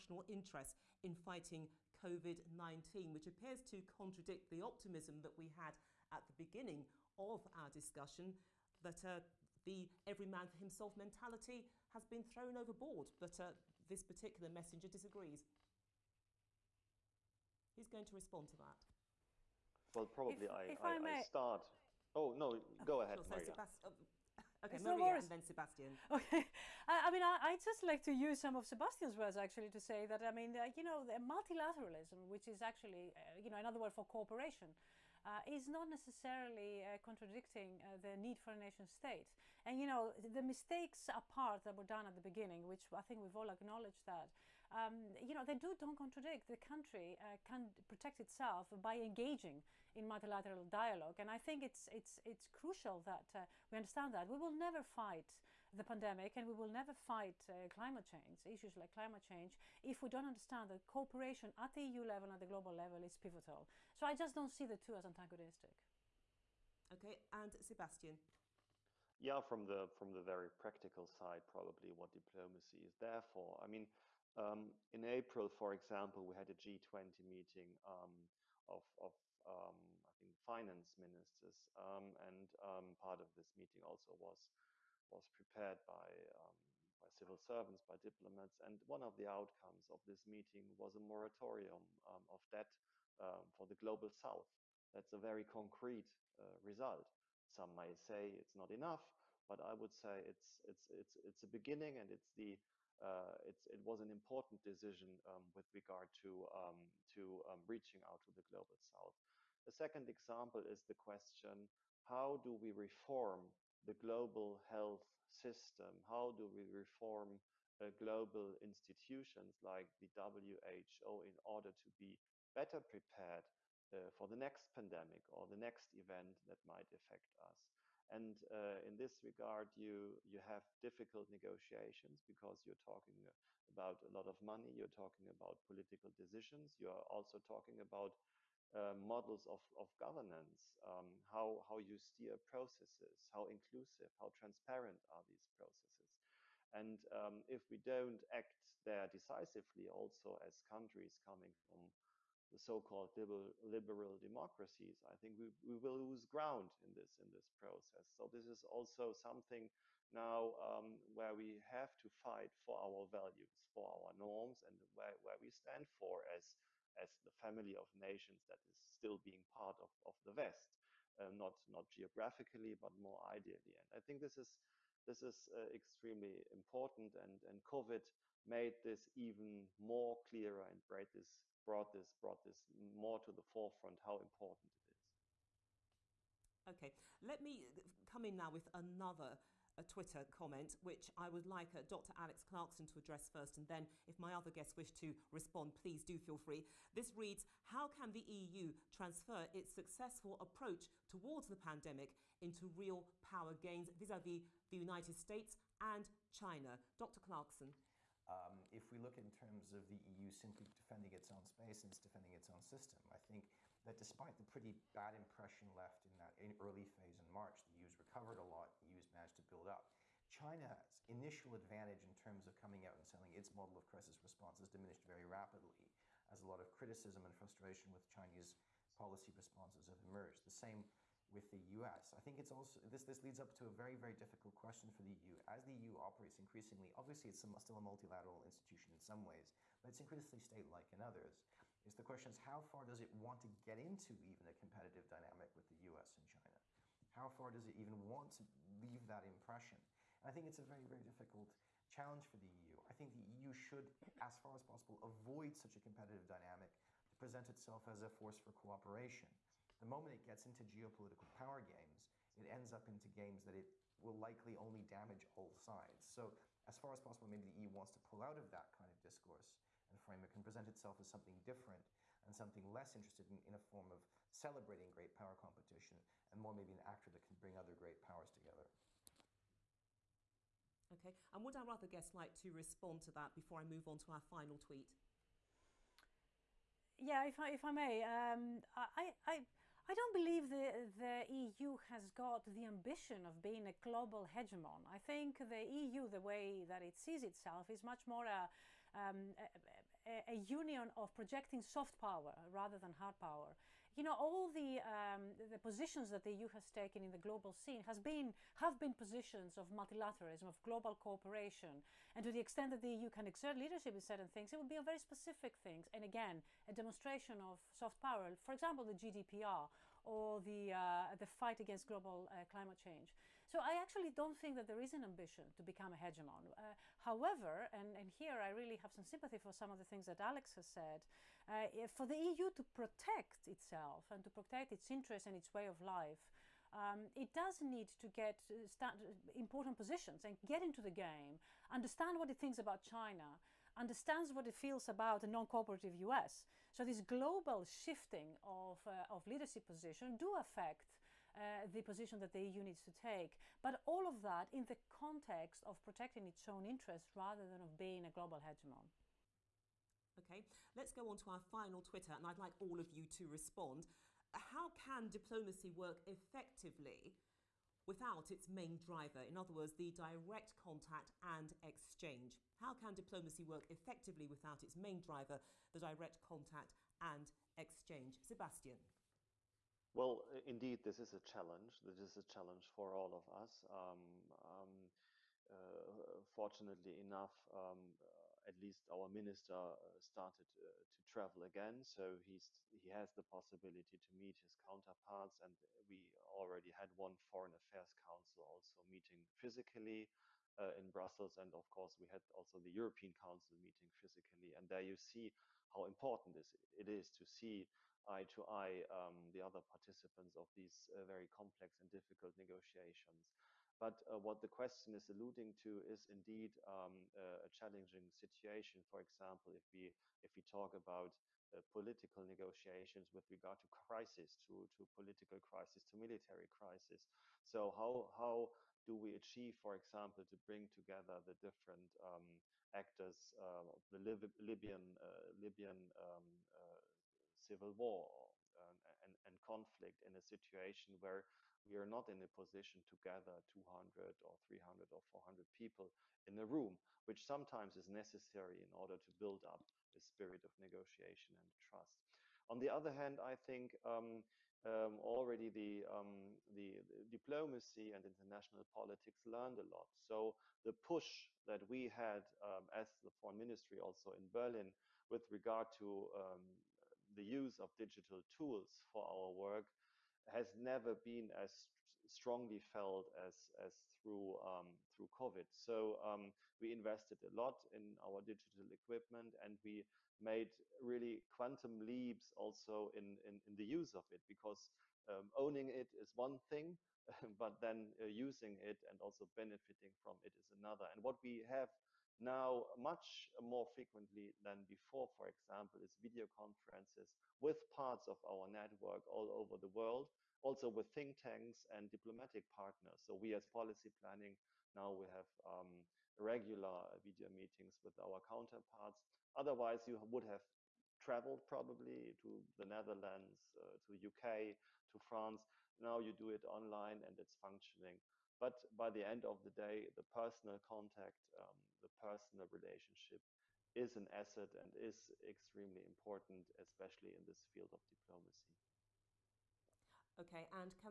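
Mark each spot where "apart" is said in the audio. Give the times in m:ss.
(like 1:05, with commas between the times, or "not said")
0:41.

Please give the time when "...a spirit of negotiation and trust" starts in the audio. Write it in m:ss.
7:29.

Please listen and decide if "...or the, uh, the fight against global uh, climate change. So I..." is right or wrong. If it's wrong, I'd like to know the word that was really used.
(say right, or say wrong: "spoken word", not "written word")
right.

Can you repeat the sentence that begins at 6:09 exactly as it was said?
In other words, the direct contact and exchange.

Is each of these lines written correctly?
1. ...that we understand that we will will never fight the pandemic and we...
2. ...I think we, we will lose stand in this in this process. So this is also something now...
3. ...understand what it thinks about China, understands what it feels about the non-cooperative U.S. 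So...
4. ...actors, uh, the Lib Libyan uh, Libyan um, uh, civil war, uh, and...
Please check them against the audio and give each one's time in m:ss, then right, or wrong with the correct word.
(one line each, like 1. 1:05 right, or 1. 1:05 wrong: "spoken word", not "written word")
1. 0:53 right
2. 2:35 wrong: "ground", not "stand"
3. 5:41 right
4. 7:12 right.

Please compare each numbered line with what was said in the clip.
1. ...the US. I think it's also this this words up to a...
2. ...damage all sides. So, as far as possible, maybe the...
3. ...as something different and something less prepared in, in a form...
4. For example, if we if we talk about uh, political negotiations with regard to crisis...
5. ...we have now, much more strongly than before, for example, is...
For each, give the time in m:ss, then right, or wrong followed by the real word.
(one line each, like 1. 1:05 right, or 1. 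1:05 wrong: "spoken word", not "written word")
1. 3:51 wrong: "leads", not "words"
2. 4:24 right
3. 4:31 wrong: "interested", not "prepared"
4. 6:58 right
5. 8:11 wrong: "frequently", not "strongly".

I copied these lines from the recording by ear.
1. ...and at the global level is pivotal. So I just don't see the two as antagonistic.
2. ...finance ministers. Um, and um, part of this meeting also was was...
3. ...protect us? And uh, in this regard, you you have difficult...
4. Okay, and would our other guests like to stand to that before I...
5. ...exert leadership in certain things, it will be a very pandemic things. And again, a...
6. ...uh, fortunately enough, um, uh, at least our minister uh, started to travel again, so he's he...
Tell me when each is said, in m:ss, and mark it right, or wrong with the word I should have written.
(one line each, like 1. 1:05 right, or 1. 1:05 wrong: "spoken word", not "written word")
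1. 1:02 right
2. 1:20 right
3. 2:06 wrong: "affect", not "protect"
4. 4:40 wrong: "respond", not "stand"
5. 5:13 wrong: "specific", not "pandemic"
6. 6:25 right.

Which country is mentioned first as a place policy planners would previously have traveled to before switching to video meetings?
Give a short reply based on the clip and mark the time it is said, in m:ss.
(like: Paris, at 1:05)
the Netherlands, at 8:32.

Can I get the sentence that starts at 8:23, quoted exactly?
So we as policy planning now we have um, regular video meetings with our counterparts.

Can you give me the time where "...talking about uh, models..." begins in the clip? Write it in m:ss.
2:17.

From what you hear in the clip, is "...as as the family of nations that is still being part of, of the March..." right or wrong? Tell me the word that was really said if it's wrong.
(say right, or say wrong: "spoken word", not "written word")
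wrong: "West", not "March".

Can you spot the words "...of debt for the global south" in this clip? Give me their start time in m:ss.
1:32.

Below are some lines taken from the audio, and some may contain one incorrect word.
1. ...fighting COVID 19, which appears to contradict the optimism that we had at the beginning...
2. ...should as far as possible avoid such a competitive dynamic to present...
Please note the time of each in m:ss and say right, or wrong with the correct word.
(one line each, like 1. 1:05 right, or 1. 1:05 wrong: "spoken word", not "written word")
1. 0:01 right
2. 4:13 right.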